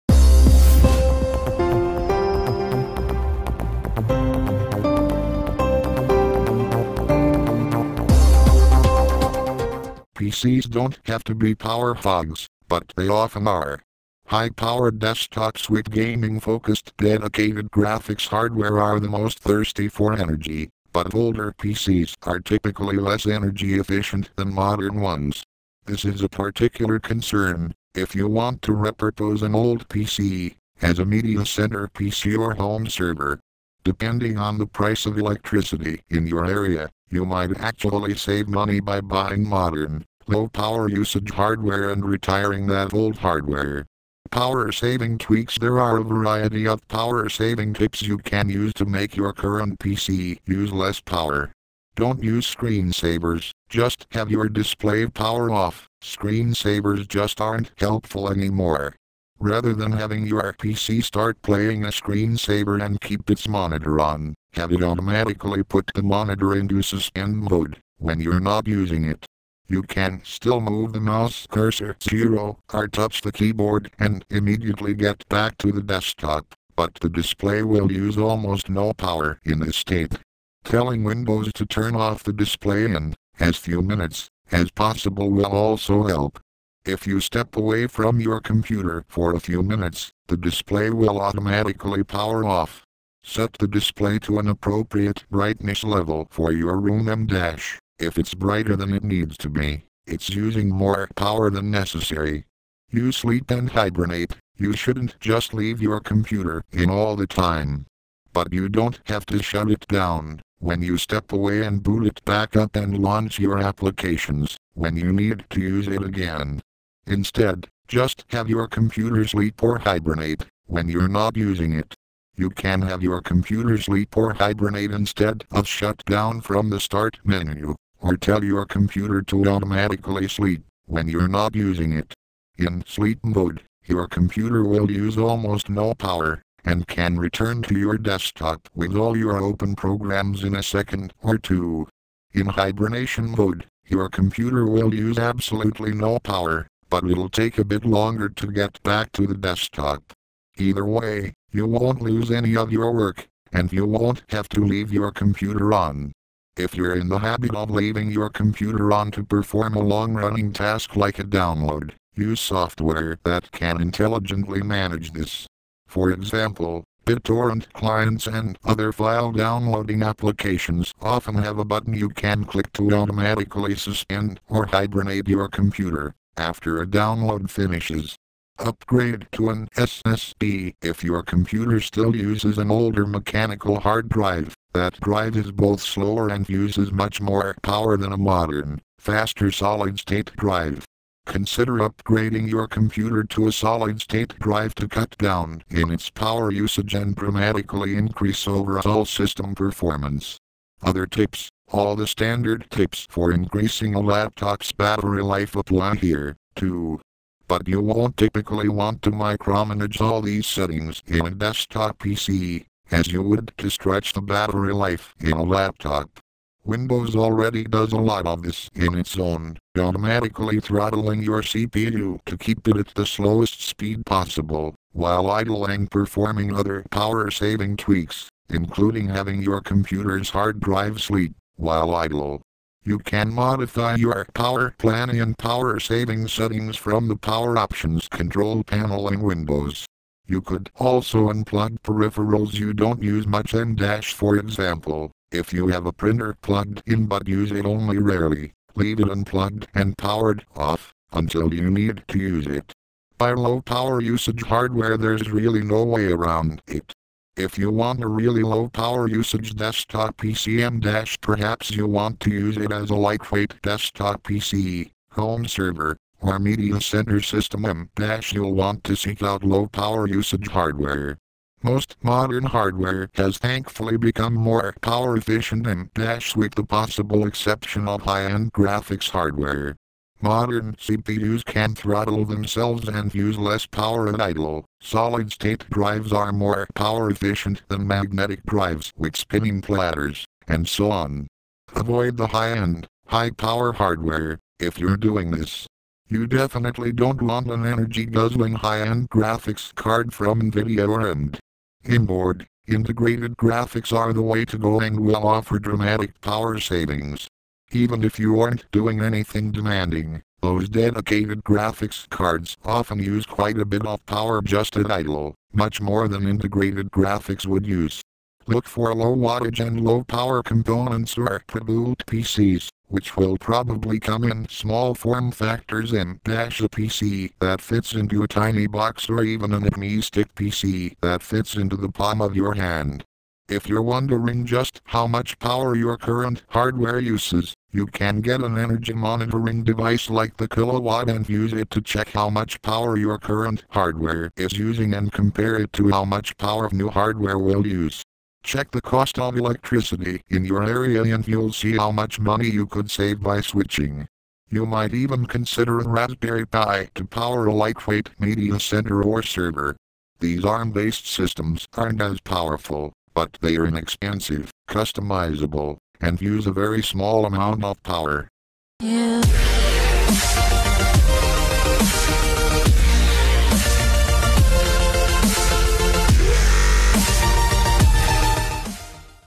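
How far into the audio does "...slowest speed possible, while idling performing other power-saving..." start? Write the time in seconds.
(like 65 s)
223 s.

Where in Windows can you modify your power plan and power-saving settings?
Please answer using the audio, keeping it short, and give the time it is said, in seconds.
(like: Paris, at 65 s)
power options control panel, at 237 s.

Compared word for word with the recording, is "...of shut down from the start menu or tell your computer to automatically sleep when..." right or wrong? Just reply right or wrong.
right.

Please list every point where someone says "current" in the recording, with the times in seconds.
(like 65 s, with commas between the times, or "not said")
49 s, 335 s, 343 s.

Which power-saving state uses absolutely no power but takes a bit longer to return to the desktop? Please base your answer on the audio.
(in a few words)
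hibernation mode.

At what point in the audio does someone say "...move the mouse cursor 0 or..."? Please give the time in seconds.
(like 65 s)
70 s.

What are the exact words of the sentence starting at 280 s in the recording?
Modern CPUs can throttle themselves and use less power at idle.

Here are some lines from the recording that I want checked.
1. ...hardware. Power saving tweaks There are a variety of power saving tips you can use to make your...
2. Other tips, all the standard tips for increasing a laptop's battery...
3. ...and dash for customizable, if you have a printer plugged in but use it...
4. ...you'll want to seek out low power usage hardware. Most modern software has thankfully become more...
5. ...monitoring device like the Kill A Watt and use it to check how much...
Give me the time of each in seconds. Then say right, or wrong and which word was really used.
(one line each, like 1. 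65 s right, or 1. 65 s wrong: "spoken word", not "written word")
1. 43 s right
2. 200 s right
3. 243 s wrong: "example", not "customizable"
4. 268 s wrong: "hardware", not "software"
5. 338 s right.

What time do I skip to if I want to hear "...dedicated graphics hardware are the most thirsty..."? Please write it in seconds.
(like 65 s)
16 s.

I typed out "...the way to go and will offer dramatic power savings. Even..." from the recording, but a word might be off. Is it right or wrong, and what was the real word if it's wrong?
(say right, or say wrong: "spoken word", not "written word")
right.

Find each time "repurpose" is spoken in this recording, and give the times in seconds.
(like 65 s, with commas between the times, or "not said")
28 s.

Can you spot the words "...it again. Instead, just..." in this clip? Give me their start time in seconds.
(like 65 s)
115 s.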